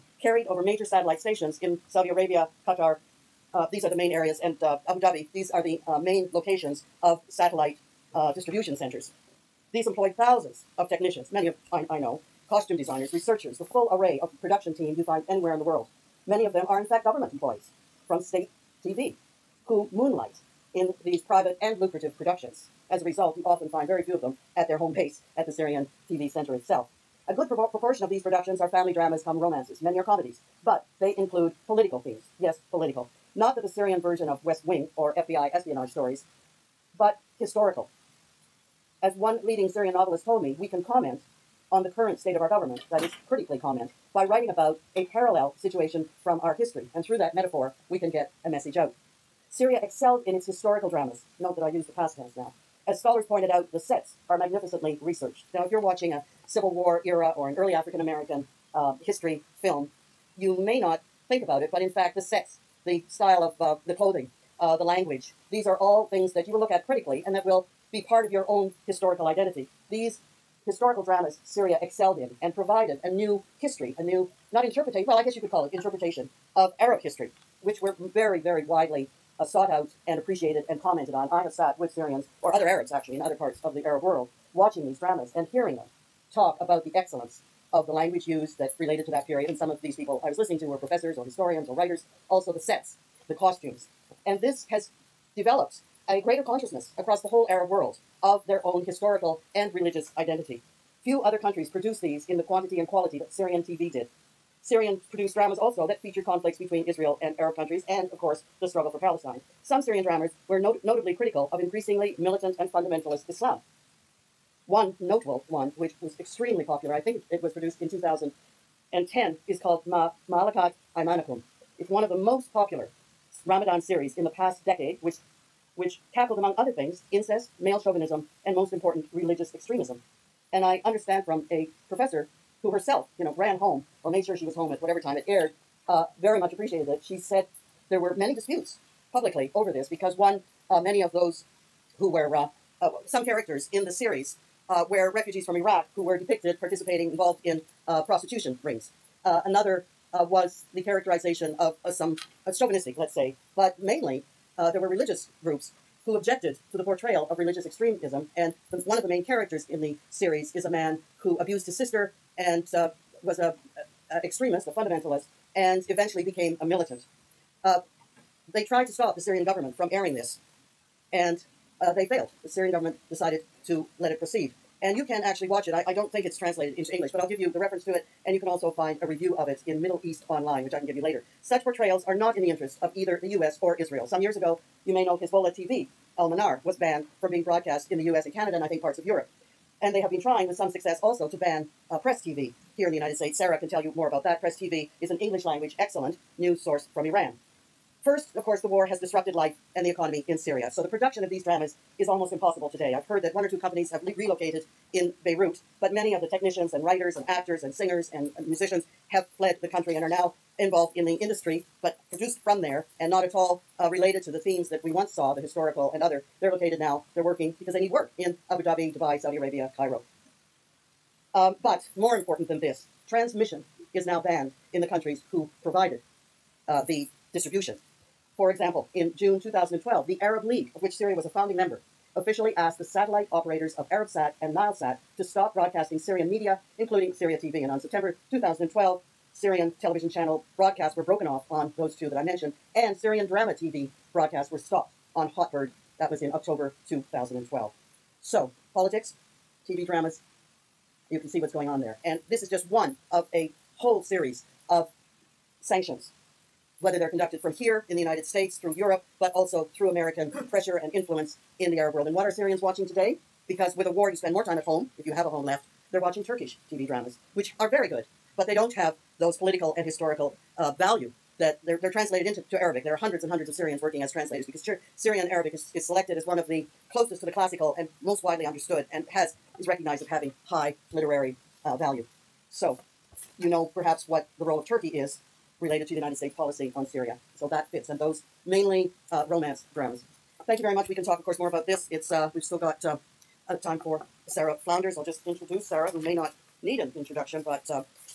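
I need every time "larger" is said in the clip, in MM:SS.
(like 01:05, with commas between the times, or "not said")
not said.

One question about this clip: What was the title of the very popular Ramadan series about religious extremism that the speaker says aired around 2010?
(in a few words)
Ma Malakat Aymanicum.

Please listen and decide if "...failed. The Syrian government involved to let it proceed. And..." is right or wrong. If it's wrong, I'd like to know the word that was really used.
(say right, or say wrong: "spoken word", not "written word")
wrong: "decided", not "involved".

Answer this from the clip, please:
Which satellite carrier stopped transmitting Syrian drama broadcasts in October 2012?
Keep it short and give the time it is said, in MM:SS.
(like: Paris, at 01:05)
Hotbird, at 04:05.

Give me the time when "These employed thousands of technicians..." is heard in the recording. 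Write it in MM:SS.
00:09.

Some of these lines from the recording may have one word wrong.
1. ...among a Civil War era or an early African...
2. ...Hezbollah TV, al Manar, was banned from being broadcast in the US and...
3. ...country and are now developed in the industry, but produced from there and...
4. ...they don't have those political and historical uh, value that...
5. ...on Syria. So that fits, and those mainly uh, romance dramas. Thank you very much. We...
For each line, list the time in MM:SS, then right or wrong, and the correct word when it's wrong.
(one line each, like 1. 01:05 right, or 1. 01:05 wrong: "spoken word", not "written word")
1. 00:55 wrong: "watching", not "among"
2. 03:05 right
3. 03:29 wrong: "involved", not "developed"
4. 04:28 right
5. 04:46 right.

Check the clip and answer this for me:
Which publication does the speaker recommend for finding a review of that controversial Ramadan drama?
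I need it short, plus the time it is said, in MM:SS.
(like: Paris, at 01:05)
Middle East Online, at 02:59.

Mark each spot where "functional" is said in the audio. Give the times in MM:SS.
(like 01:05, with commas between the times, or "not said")
not said.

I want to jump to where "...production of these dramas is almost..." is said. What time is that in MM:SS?
03:20.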